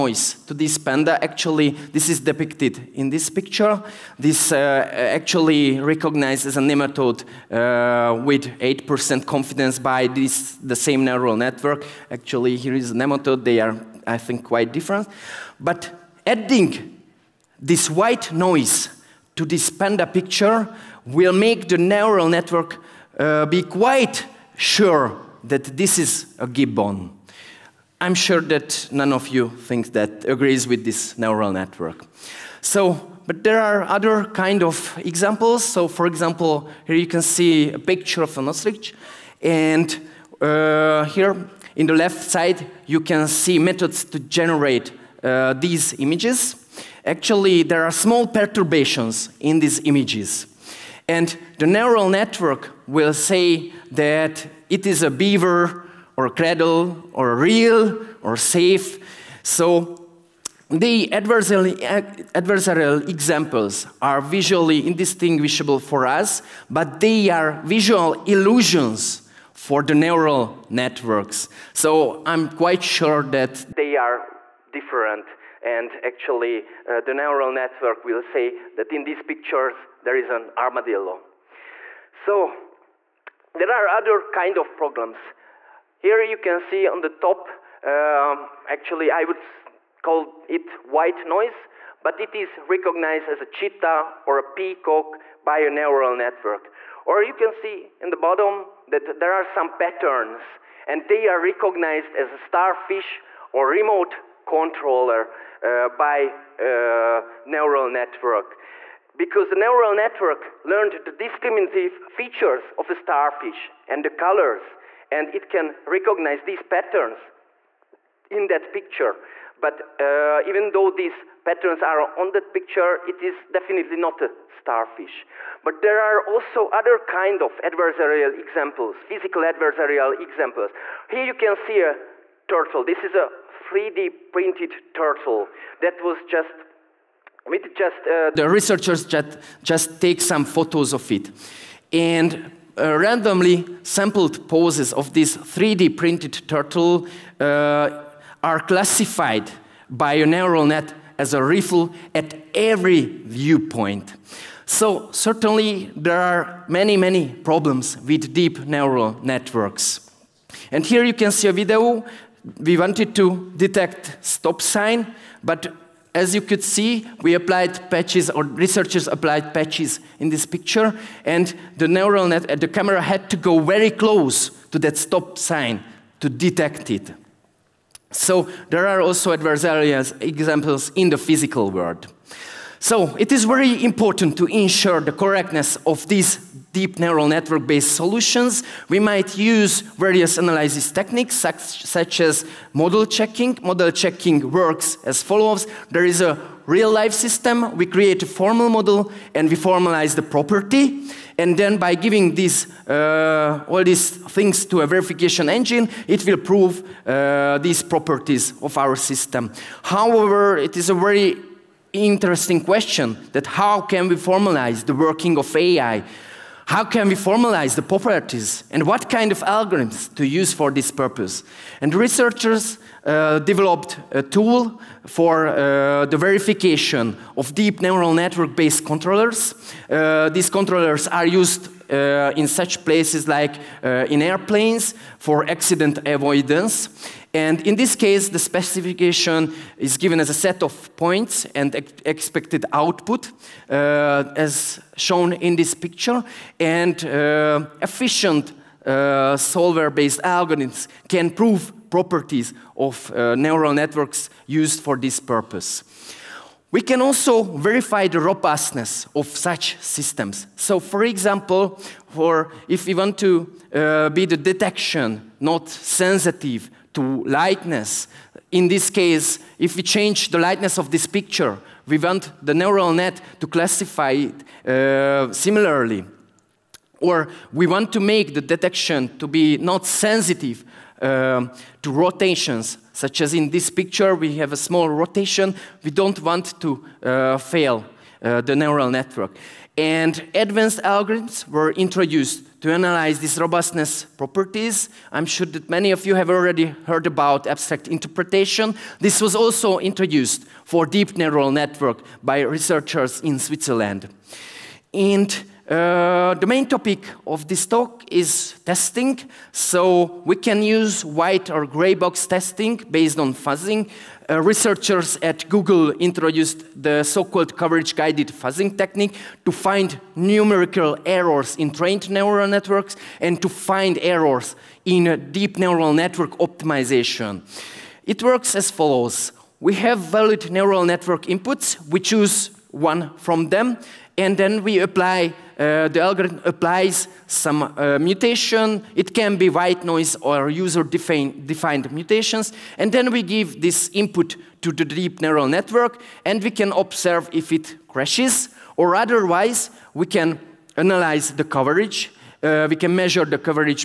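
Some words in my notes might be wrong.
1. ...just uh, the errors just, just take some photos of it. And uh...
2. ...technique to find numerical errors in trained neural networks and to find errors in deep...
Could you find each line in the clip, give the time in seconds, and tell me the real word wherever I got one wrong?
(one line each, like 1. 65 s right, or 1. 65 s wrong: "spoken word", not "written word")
1. 137 s wrong: "researchers", not "errors"
2. 318 s right.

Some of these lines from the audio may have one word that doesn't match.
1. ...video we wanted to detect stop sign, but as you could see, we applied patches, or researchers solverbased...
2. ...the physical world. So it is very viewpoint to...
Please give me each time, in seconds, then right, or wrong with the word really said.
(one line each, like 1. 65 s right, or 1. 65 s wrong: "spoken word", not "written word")
1. 161 s wrong: "applied", not "solverbased"
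2. 181 s wrong: "important", not "viewpoint".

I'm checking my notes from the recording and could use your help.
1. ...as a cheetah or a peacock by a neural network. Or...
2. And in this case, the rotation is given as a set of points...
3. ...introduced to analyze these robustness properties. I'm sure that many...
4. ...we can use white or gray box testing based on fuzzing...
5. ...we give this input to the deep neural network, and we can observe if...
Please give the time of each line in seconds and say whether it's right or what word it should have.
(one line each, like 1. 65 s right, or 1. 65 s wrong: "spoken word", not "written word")
1. 93 s right
2. 237 s wrong: "specification", not "rotation"
3. 291 s right
4. 310 s right
5. 343 s right.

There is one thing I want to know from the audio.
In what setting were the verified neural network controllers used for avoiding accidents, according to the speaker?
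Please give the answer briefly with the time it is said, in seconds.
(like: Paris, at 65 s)
airplanes, at 234 s.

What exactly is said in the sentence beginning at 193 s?
Model checking works as follows there is a real life system, we create a formal model, and we formalize the property.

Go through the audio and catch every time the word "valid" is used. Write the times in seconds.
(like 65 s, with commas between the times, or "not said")
329 s.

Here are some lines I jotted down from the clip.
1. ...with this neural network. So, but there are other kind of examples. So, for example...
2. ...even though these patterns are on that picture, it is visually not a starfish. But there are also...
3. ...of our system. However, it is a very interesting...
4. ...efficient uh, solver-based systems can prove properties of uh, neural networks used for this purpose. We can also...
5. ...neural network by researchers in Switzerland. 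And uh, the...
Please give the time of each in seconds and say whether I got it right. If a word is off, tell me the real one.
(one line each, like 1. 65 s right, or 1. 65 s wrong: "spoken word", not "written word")
1. 30 s right
2. 120 s wrong: "definitely", not "visually"
3. 208 s right
4. 247 s wrong: "algorithms", not "systems"
5. 301 s right.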